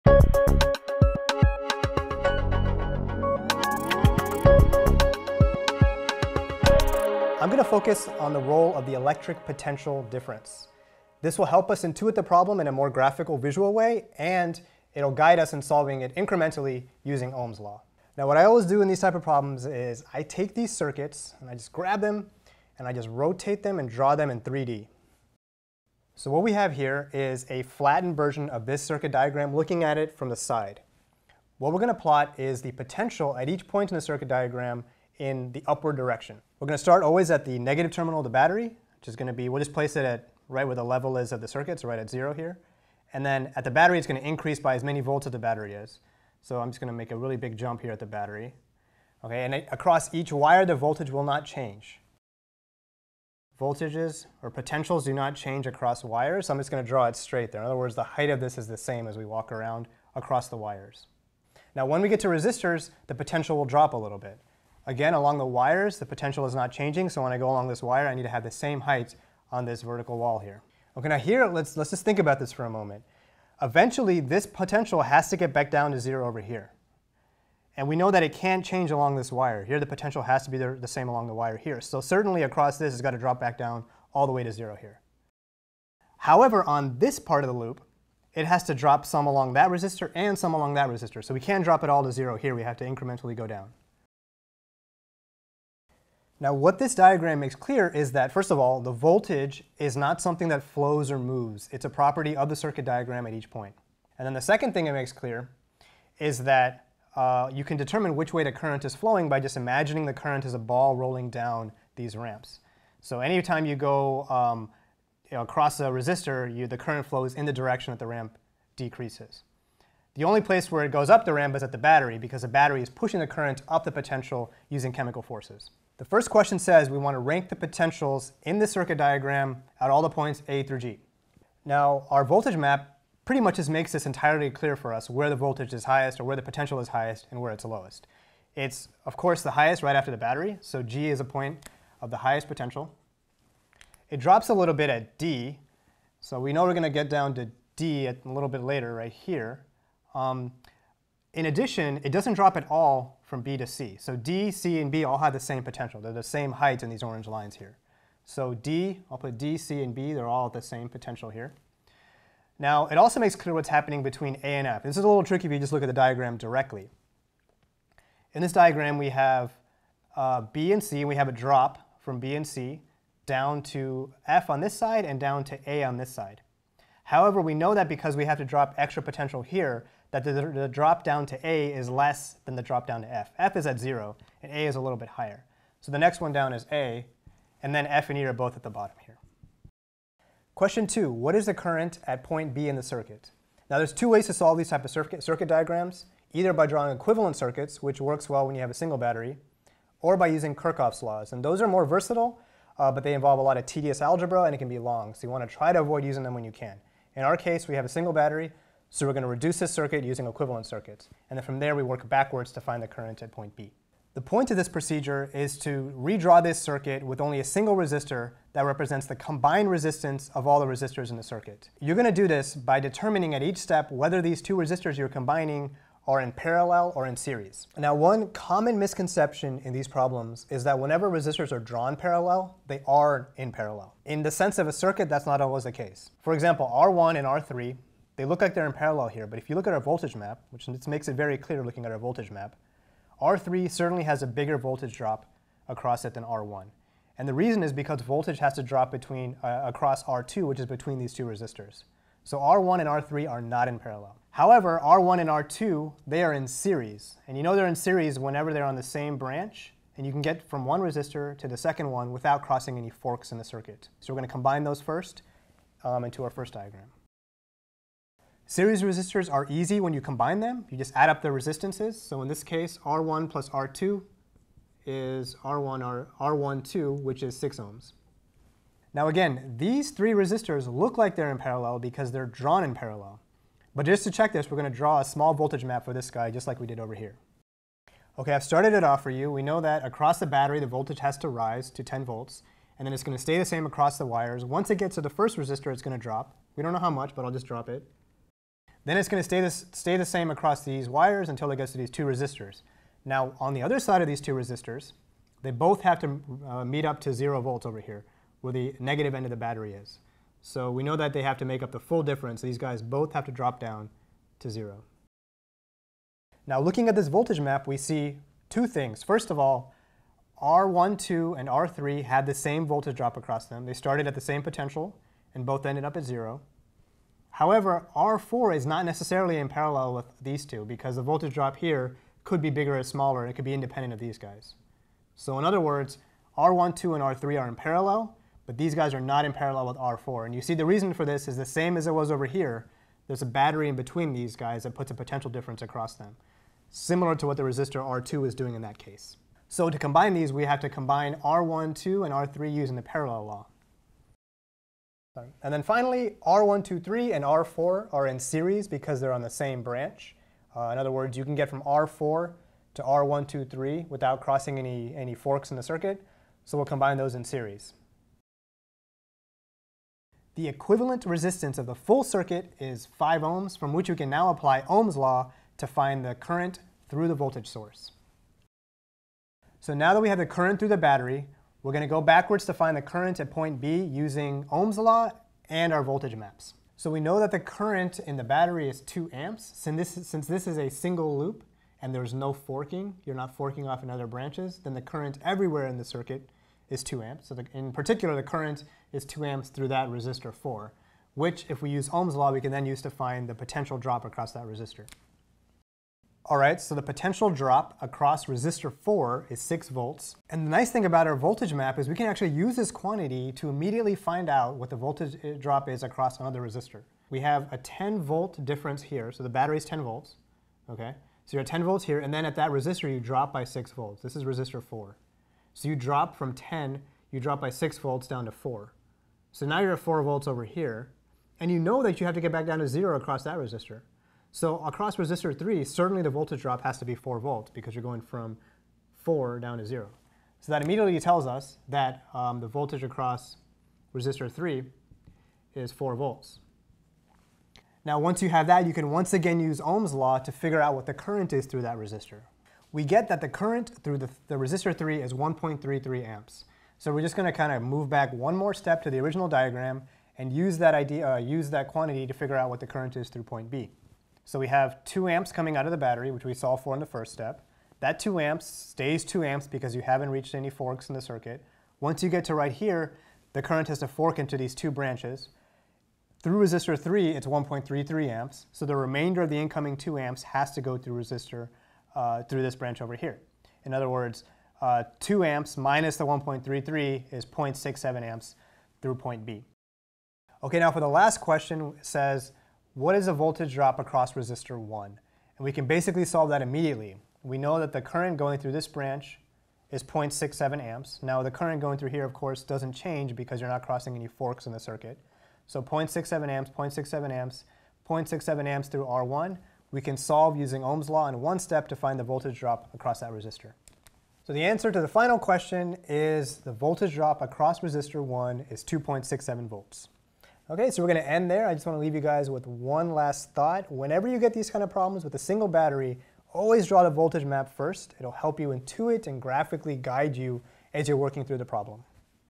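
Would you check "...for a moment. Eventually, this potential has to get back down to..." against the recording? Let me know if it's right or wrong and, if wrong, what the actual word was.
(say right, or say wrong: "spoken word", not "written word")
right.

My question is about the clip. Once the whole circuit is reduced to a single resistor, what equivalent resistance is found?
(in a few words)
5 ohms.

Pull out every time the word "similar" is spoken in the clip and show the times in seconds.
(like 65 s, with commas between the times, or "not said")
346 s.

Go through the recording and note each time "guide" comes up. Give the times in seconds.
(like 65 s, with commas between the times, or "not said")
15 s, 529 s.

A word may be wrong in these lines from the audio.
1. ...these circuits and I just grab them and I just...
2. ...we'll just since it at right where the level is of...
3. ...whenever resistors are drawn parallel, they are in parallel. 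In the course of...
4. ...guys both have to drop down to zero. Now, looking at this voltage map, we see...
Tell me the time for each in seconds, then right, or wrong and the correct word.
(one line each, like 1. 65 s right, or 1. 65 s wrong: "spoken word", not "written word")
1. 20 s right
2. 39 s wrong: "place", not "since"
3. 230 s wrong: "sense", not "course"
4. 312 s right.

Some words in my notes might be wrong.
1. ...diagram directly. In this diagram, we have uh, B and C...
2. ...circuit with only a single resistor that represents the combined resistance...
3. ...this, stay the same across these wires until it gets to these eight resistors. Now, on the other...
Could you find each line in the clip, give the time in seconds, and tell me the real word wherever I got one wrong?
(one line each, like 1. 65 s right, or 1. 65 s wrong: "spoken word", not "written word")
1. 165 s right
2. 216 s right
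3. 299 s wrong: "two", not "eight".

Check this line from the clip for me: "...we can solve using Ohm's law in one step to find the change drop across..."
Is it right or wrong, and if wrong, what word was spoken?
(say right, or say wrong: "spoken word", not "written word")
wrong: "voltage", not "change".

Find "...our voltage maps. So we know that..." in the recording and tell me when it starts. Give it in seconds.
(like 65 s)
385 s.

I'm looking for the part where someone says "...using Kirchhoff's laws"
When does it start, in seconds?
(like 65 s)
200 s.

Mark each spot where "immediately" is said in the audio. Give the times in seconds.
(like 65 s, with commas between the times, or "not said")
413 s, 440 s, 496 s.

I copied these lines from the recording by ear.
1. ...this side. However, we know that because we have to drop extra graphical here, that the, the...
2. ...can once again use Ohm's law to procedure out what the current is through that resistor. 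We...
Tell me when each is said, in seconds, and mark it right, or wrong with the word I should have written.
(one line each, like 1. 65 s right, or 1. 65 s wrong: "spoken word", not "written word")
1. 175 s wrong: "potential", not "graphical"
2. 448 s wrong: "figure", not "procedure".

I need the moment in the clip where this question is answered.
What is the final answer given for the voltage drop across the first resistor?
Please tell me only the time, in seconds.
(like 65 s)
518 s.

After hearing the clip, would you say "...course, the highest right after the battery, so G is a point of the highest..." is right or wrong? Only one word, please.
right.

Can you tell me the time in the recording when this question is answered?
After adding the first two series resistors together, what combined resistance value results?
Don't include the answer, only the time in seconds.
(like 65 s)
277 s.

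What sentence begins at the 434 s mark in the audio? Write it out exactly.
So across resistor 3, certainly the voltage drop has to be 4 volts because you're going from 4 down to 0.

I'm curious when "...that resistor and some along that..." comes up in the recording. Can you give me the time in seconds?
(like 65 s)
89 s.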